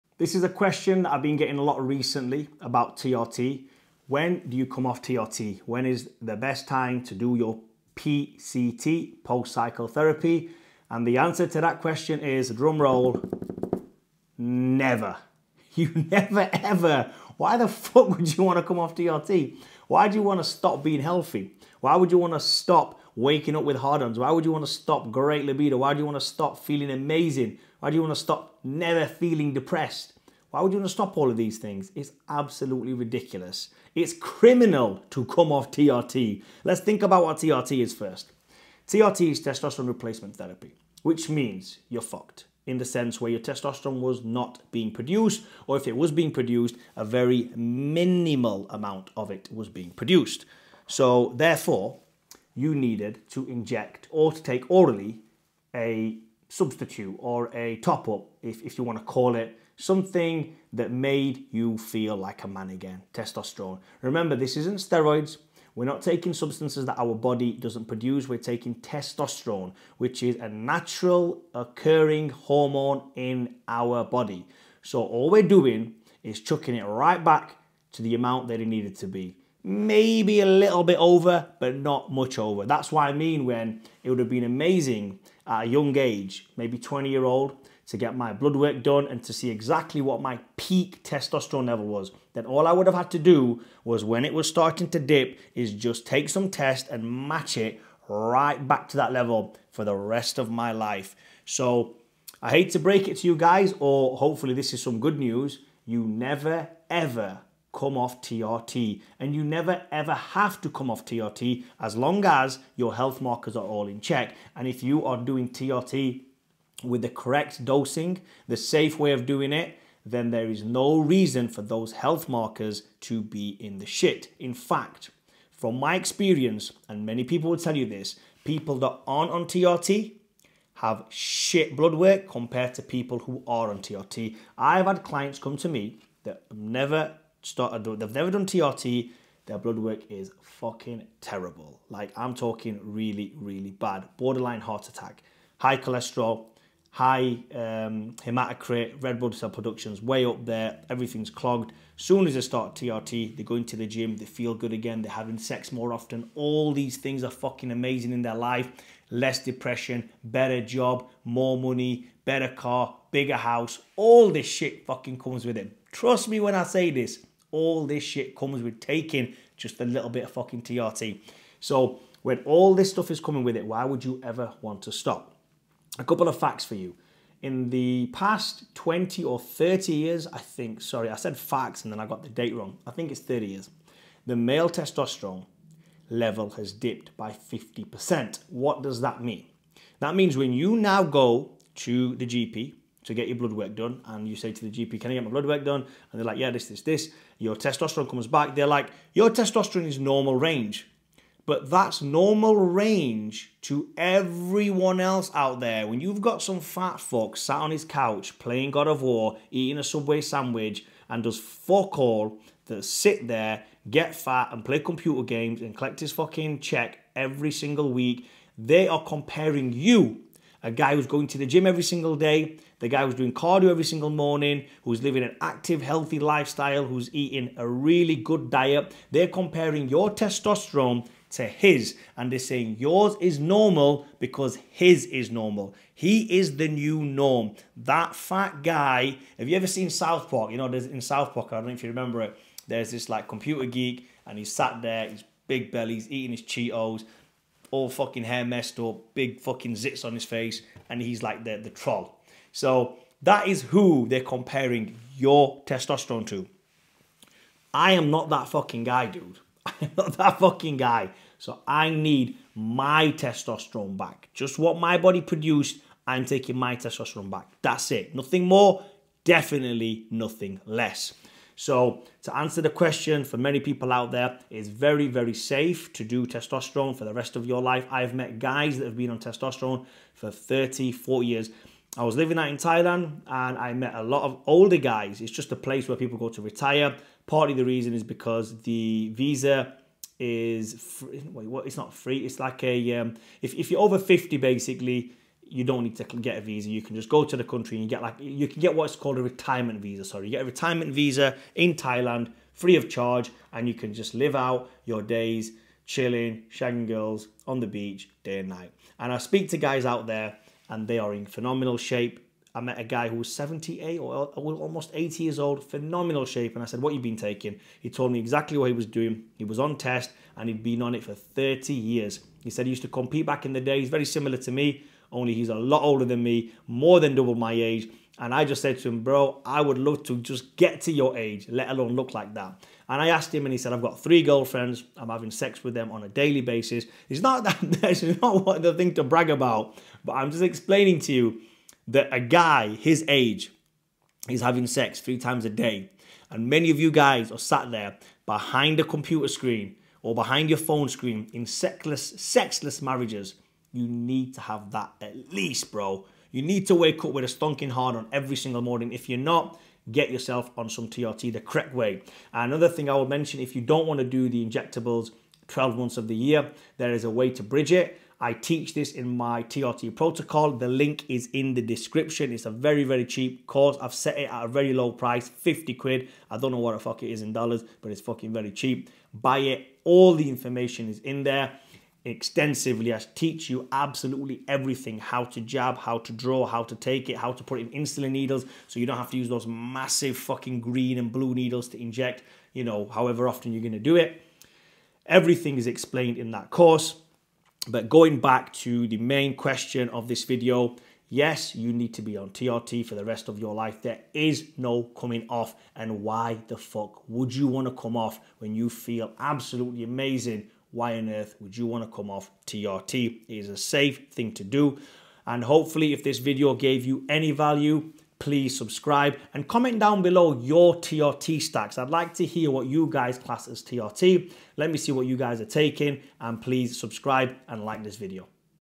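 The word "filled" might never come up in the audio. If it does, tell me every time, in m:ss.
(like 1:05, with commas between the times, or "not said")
not said.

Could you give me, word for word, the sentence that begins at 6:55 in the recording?
And hopefully, if this video gave you any value, please subscribe and comment down below your TRT stacks.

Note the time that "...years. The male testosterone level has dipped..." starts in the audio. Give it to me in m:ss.
3:03.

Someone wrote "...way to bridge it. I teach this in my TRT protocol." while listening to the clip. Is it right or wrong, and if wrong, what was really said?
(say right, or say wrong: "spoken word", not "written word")
right.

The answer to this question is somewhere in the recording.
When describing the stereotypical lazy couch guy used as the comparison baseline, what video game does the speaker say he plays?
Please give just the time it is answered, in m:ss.
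3:28.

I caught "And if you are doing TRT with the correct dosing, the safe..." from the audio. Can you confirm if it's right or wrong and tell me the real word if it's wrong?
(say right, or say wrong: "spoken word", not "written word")
right.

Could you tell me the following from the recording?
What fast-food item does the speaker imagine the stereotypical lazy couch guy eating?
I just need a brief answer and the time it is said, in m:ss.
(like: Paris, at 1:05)
Subway sandwich, at 3:29.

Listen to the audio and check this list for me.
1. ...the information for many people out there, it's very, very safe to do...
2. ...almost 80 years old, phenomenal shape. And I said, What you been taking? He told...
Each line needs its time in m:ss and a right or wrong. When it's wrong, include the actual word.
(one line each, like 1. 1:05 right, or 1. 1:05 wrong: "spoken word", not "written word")
1. 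4:32 wrong: "question", not "information"
2. 5:14 right.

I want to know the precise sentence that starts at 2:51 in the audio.
So when all this stuff is coming with it, why would you ever want to stop?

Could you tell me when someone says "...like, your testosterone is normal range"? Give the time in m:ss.
3:18.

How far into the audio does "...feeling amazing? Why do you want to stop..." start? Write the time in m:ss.
0:26.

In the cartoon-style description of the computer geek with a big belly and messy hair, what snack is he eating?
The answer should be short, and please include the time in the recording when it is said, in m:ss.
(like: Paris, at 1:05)
Cheetos, at 4:06.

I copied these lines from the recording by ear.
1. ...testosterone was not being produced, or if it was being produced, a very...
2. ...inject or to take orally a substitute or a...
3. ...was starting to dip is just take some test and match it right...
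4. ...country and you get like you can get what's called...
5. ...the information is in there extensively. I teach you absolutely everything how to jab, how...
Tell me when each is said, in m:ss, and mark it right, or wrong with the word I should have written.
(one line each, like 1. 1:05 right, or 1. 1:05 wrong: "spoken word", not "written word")
1. 0:43 right
2. 0:53 right
3. 1:34 right
4. 4:57 right
5. 6:20 right.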